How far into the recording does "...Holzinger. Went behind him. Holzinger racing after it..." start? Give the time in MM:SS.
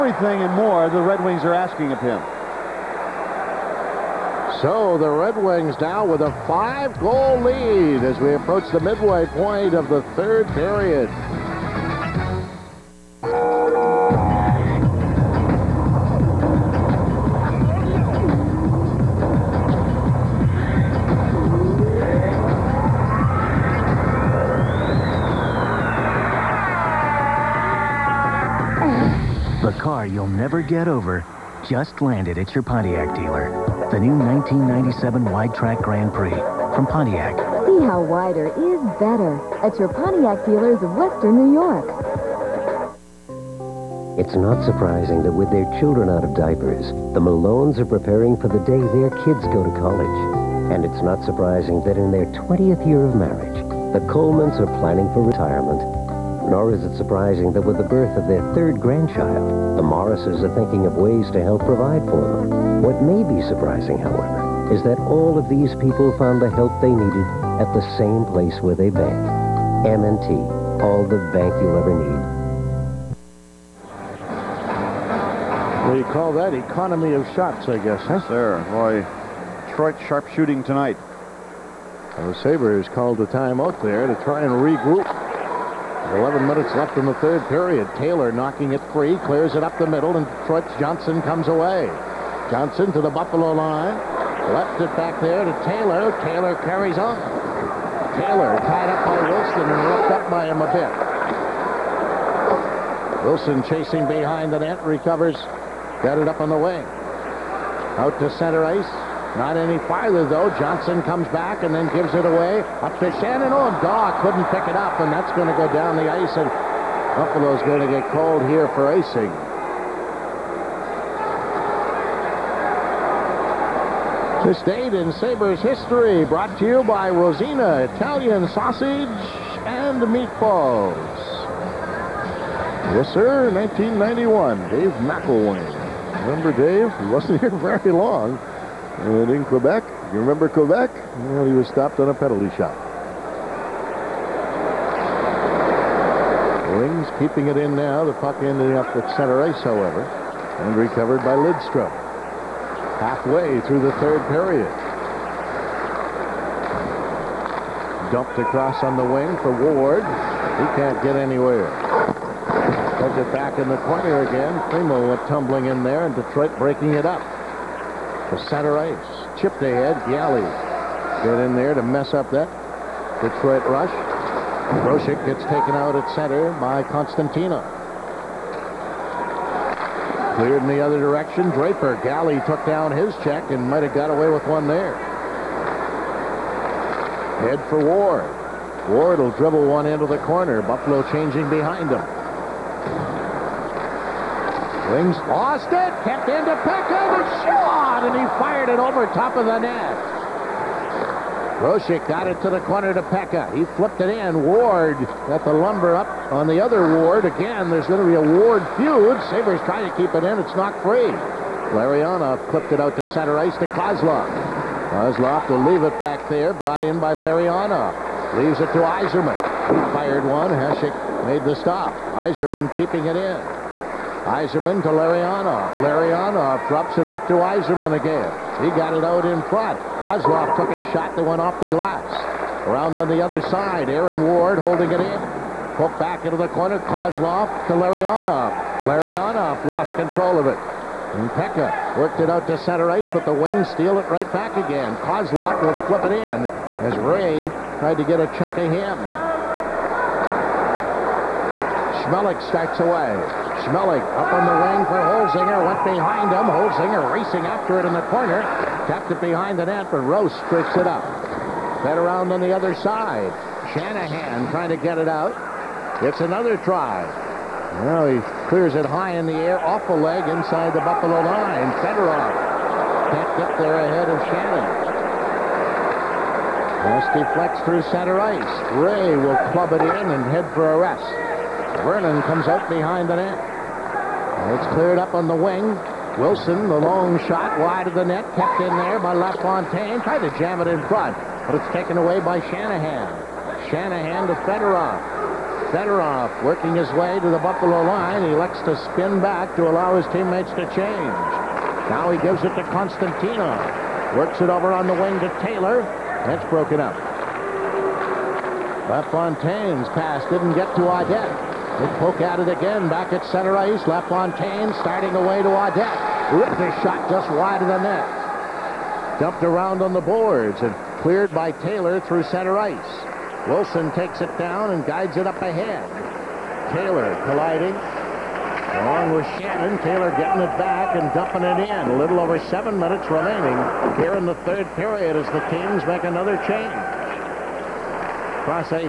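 04:14.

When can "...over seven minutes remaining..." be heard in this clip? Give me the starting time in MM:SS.
05:32.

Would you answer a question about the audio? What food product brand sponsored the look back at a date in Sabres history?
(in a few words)
Rosina Italian Sausage.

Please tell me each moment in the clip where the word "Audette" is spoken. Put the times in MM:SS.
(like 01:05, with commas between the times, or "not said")
05:10, 05:15.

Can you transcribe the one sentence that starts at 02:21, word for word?
Well, he was stopped on a penalty shot.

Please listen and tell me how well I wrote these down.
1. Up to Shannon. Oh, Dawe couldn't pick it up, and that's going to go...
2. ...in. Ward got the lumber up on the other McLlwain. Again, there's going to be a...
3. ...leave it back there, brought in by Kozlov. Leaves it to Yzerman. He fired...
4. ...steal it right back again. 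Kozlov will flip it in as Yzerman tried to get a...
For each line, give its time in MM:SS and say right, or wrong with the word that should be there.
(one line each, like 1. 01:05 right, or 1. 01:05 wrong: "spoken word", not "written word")
1. 01:52 right
2. 03:24 wrong: "Ward", not "McLlwain"
3. 03:35 wrong: "Larionov", not "Kozlov"
4. 04:03 wrong: "Ray", not "Yzerman".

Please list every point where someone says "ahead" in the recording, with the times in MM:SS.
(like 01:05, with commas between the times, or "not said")
02:49, 04:33, 05:25.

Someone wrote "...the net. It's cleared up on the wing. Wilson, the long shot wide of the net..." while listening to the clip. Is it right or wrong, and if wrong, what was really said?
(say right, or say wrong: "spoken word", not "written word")
right.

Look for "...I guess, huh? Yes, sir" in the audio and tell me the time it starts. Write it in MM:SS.
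01:17.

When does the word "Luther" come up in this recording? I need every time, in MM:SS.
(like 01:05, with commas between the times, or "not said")
not said.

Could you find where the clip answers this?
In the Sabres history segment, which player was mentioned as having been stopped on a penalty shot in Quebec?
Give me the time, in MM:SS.
02:14.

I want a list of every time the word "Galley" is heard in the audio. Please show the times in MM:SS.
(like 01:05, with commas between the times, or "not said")
02:50, 03:02.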